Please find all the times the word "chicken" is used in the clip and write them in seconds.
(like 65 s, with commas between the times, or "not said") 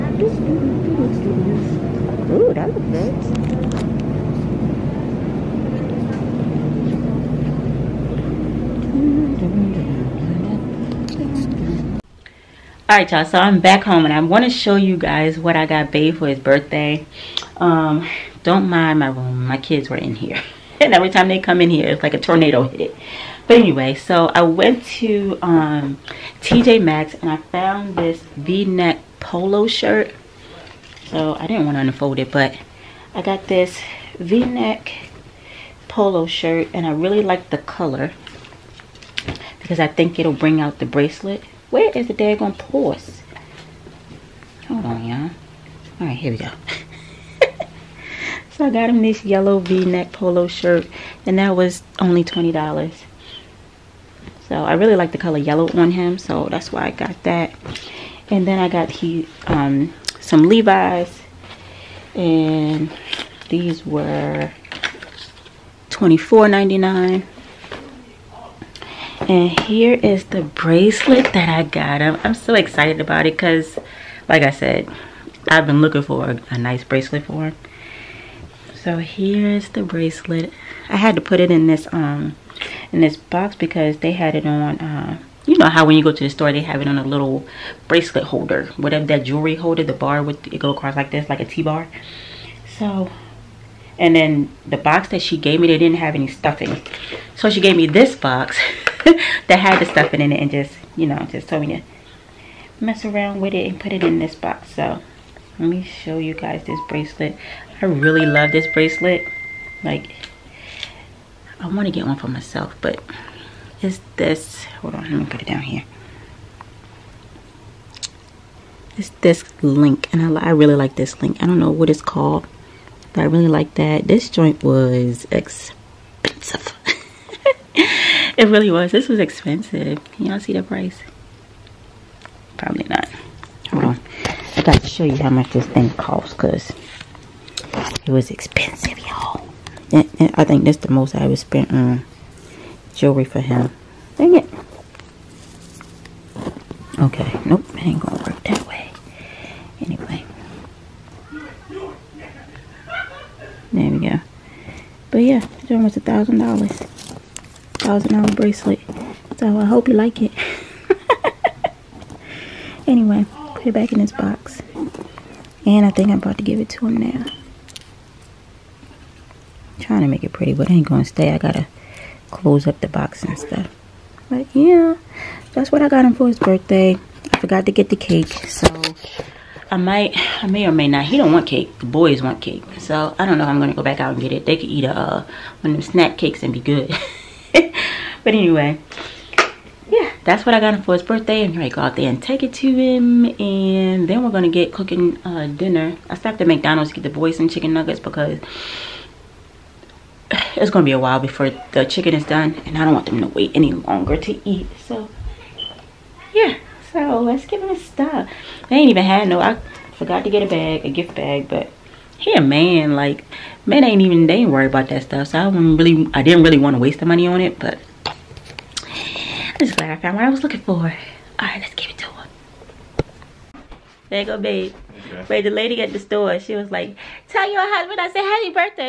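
197 s, 201 s.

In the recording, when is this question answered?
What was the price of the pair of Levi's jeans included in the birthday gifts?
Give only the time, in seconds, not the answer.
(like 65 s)
65 s.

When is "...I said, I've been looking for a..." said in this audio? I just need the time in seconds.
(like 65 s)
74 s.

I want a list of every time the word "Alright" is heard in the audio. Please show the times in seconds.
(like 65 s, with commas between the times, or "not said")
12 s.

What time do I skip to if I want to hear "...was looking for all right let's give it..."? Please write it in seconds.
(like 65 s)
220 s.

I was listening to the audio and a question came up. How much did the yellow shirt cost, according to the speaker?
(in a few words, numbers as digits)
$20.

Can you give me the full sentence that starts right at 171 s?
I gotta close up the box and stuff.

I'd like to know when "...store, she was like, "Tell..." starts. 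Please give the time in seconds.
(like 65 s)
225 s.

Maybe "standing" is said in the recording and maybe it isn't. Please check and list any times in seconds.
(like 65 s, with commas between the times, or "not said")
not said.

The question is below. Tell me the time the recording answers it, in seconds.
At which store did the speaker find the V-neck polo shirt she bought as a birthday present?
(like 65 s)
26 s.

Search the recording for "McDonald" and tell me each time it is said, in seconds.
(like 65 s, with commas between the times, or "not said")
196 s.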